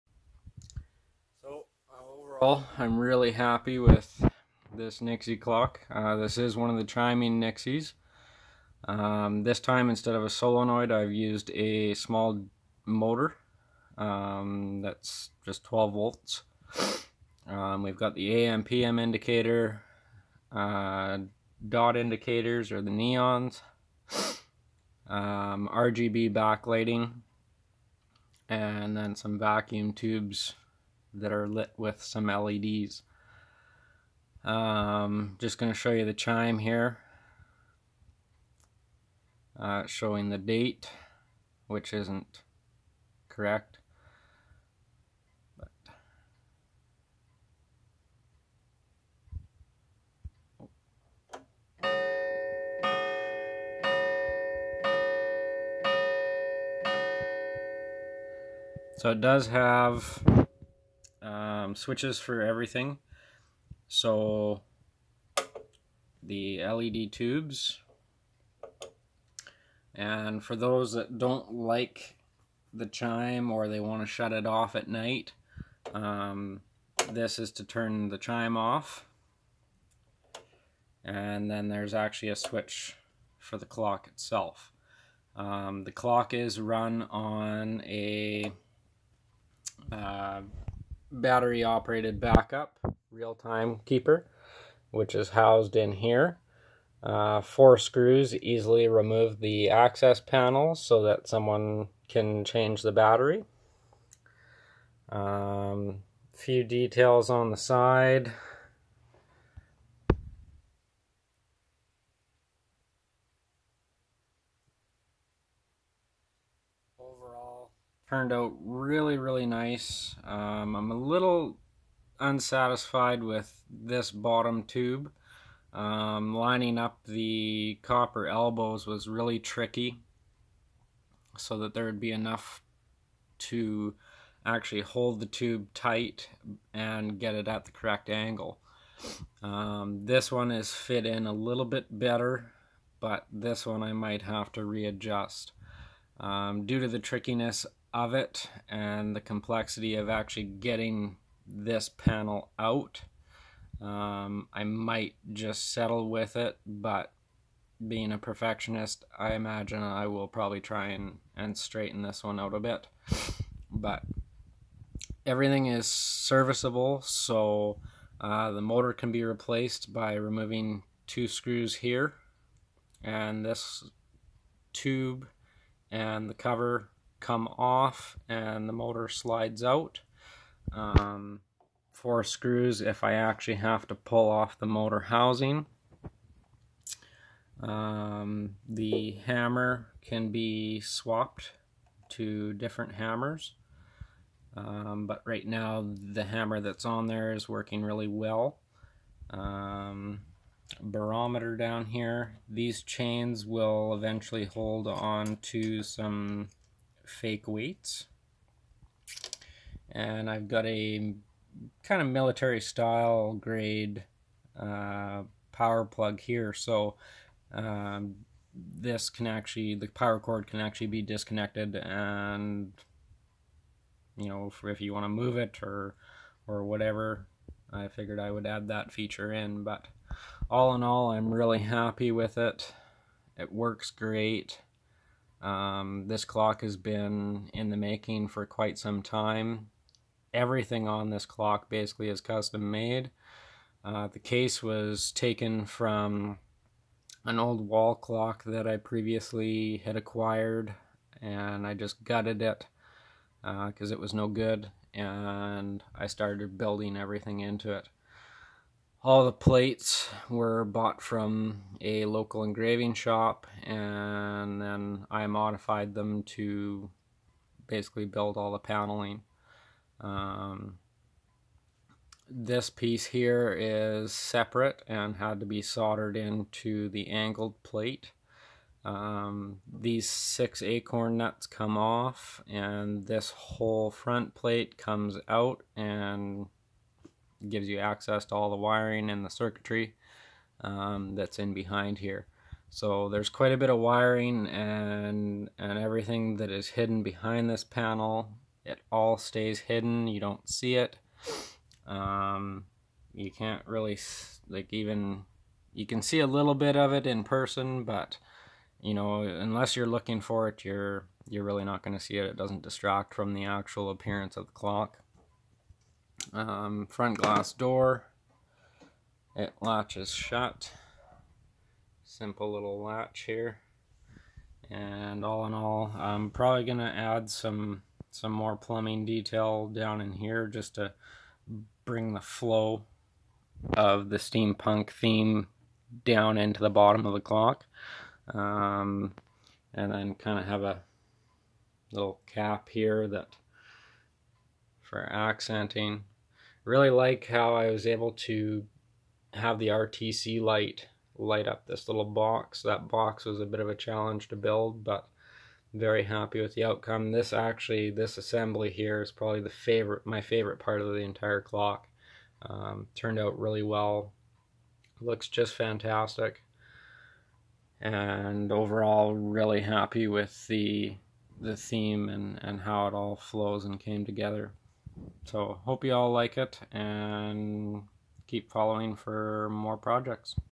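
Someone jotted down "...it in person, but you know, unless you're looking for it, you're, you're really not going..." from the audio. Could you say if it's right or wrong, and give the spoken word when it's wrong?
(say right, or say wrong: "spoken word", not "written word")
right.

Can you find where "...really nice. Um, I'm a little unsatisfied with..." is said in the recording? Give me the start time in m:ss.
1:59.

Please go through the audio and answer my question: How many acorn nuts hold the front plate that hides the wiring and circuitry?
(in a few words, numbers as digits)
6.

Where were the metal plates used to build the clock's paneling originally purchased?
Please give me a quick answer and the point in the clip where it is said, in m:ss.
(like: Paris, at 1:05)
a local engraving shop, at 4:22.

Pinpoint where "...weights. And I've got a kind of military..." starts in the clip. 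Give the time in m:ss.
3:27.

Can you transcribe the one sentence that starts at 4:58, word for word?
It all stays hidden, you don't see it.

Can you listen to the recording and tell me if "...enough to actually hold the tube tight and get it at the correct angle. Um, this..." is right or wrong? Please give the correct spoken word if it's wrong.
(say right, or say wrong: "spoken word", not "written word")
right.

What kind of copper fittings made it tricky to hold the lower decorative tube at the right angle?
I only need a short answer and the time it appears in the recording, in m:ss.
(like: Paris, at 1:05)
copper elbows, at 2:07.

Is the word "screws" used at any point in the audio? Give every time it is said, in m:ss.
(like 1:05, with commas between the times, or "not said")
1:37, 2:51, 3:02.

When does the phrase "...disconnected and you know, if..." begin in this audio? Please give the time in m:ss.
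3:41.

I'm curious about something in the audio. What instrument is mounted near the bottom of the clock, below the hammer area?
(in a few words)
barometer.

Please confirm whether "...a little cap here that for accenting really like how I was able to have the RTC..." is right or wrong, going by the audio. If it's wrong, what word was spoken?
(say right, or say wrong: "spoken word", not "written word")
right.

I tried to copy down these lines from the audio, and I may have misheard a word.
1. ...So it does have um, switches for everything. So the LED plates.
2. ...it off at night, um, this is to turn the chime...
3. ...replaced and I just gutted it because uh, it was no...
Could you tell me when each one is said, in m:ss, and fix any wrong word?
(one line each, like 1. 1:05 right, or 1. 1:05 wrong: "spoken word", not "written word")
1. 0:58 wrong: "tubes", not "plates"
2. 1:14 right
3. 4:09 wrong: "acquired", not "replaced".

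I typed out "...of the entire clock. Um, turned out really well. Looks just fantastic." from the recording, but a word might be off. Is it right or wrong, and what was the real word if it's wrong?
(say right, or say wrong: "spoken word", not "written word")
right.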